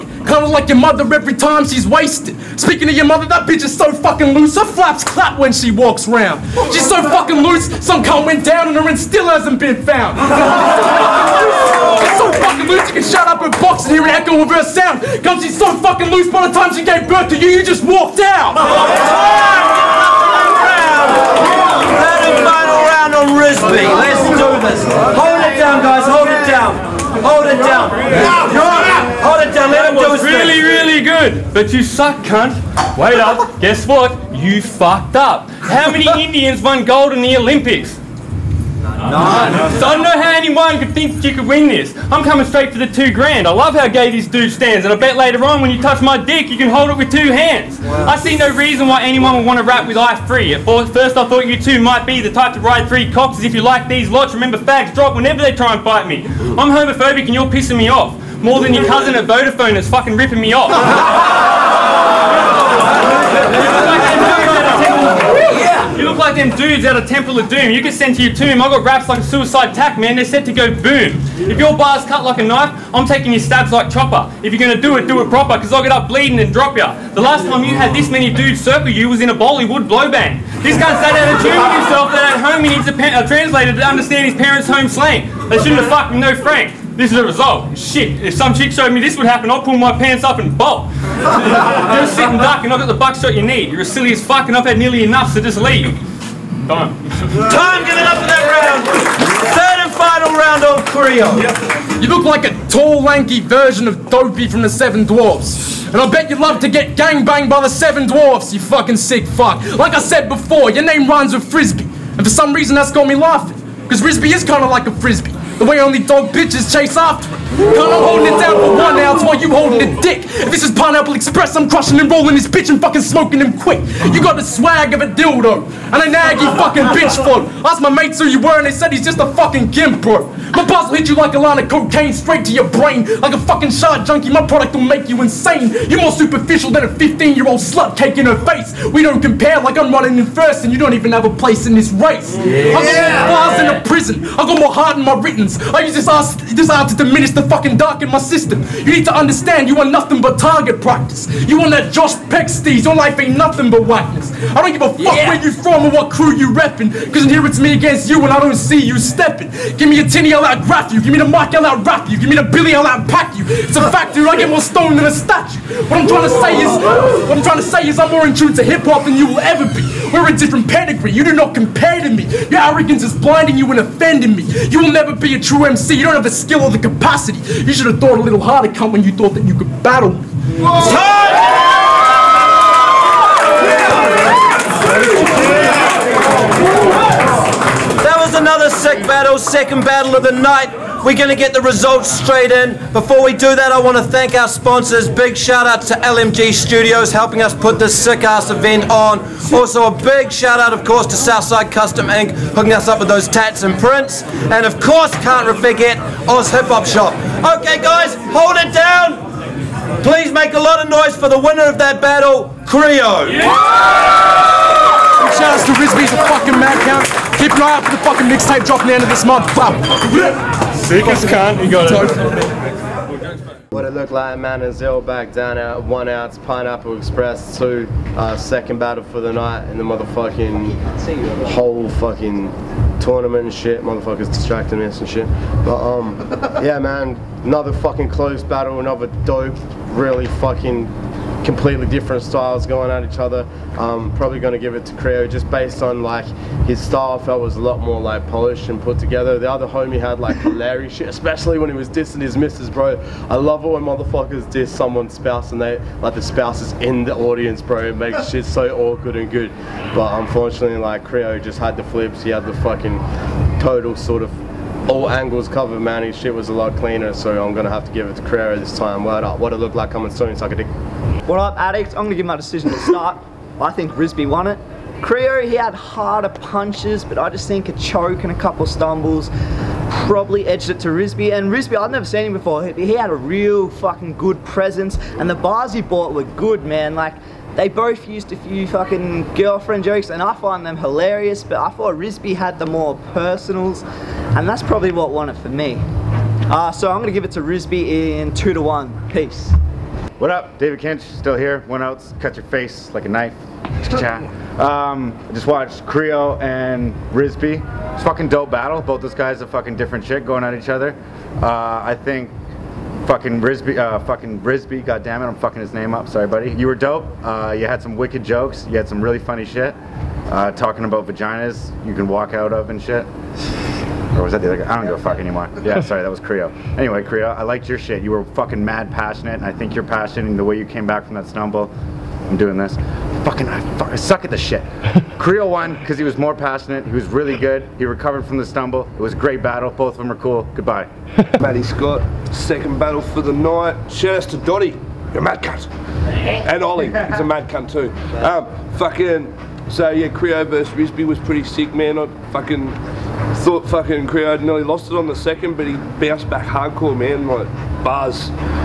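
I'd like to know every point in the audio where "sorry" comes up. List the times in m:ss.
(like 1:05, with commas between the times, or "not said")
5:16, 5:25.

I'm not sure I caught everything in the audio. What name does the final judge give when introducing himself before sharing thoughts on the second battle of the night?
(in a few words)
Matty Scott.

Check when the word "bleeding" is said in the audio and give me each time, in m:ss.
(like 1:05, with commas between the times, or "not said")
1:16.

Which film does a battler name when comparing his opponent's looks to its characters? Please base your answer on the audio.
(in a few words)
Temple of Doom.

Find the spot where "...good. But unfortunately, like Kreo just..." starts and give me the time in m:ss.
4:19.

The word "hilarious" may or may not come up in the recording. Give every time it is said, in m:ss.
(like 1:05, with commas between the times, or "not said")
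4:10, 4:50.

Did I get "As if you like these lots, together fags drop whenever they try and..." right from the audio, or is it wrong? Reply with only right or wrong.
wrong.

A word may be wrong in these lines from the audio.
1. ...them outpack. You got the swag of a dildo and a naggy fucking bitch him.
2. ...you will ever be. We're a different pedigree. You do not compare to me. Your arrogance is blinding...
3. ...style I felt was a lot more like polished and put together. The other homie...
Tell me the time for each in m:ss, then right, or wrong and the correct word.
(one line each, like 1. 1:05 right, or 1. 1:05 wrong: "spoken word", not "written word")
1. 2:03 wrong: "quick", not "outpack"
2. 2:49 right
3. 4:06 right.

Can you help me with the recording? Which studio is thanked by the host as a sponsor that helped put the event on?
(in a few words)
LMG Studios.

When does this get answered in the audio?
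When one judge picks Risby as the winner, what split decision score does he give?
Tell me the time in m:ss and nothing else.
4:58.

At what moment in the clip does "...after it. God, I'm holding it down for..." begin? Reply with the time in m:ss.
1:56.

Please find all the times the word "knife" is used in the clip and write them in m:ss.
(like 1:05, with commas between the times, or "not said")
1:12, 5:03.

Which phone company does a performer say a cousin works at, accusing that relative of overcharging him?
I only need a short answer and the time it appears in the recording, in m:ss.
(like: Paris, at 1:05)
Vodafone, at 0:59.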